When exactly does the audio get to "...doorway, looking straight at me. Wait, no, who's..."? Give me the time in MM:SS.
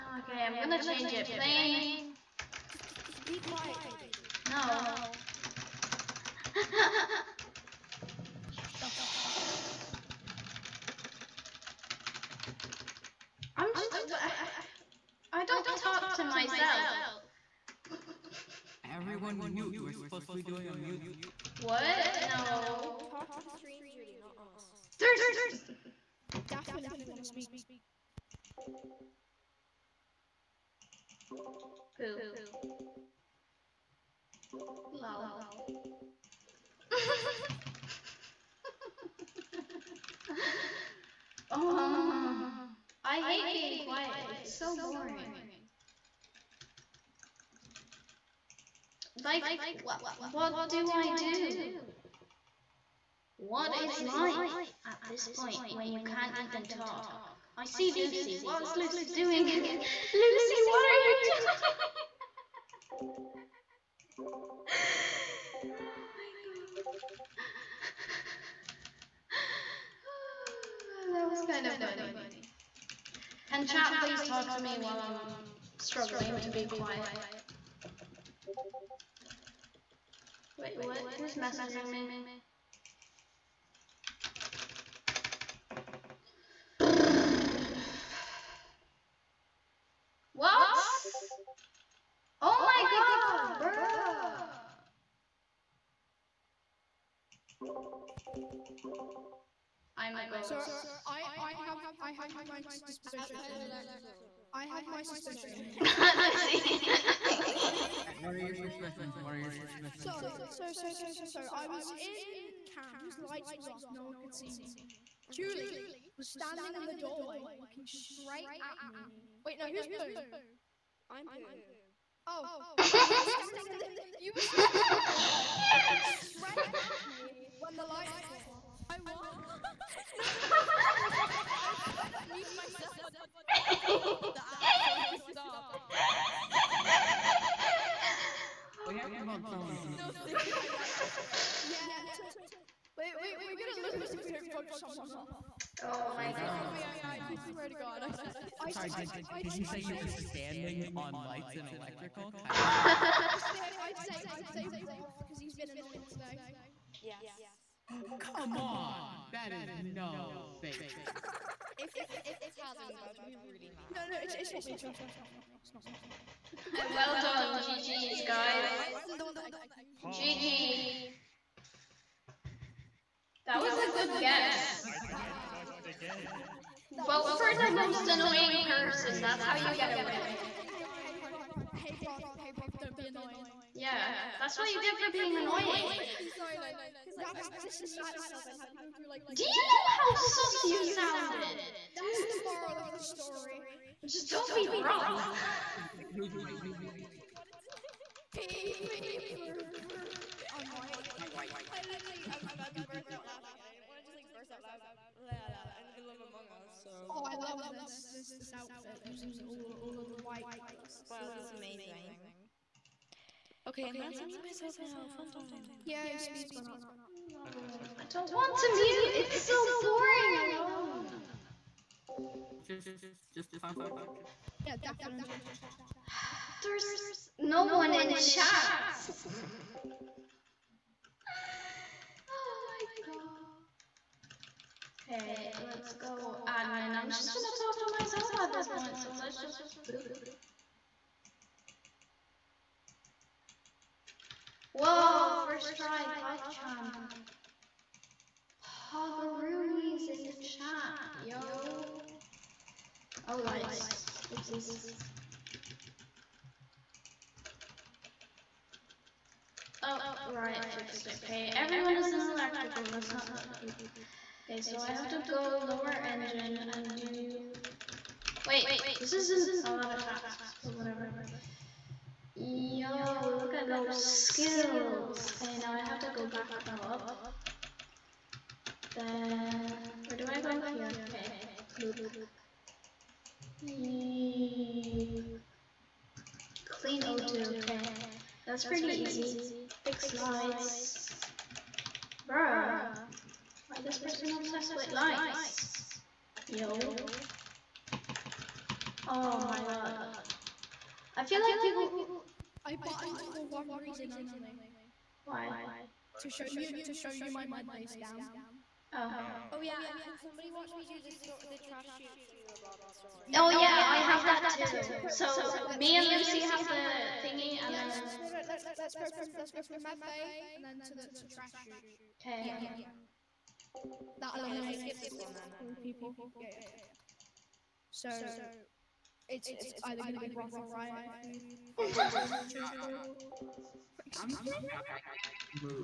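01:56.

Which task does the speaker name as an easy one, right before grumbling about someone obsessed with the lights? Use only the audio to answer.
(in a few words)
Clean O2.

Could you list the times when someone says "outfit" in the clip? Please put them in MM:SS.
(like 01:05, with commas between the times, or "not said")
03:28.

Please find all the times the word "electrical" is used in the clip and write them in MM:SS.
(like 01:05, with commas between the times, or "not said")
01:43, 02:31, 04:22.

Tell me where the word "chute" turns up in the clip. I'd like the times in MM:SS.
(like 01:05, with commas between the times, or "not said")
05:11, 05:21.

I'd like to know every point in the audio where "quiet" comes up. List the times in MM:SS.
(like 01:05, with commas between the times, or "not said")
00:03, 00:43, 01:16.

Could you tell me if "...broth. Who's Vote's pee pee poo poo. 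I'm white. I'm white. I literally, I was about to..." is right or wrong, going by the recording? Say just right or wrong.
wrong.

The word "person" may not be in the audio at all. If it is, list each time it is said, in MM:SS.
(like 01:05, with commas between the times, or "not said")
02:58, 04:53.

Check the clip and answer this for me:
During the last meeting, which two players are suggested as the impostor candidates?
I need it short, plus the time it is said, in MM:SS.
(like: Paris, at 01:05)
Broth or Riot, at 05:30.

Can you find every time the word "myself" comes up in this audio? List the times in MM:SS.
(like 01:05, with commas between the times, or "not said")
00:16, 02:12, 03:08, 03:34, 03:57.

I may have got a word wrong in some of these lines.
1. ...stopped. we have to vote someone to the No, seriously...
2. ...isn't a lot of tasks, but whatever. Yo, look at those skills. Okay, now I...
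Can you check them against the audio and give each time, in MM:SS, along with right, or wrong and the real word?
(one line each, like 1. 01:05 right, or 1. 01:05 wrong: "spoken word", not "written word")
1. 02:15 right
2. 04:29 right.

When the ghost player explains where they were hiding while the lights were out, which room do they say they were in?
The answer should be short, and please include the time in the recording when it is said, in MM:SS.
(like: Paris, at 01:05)
Cams, at 01:52.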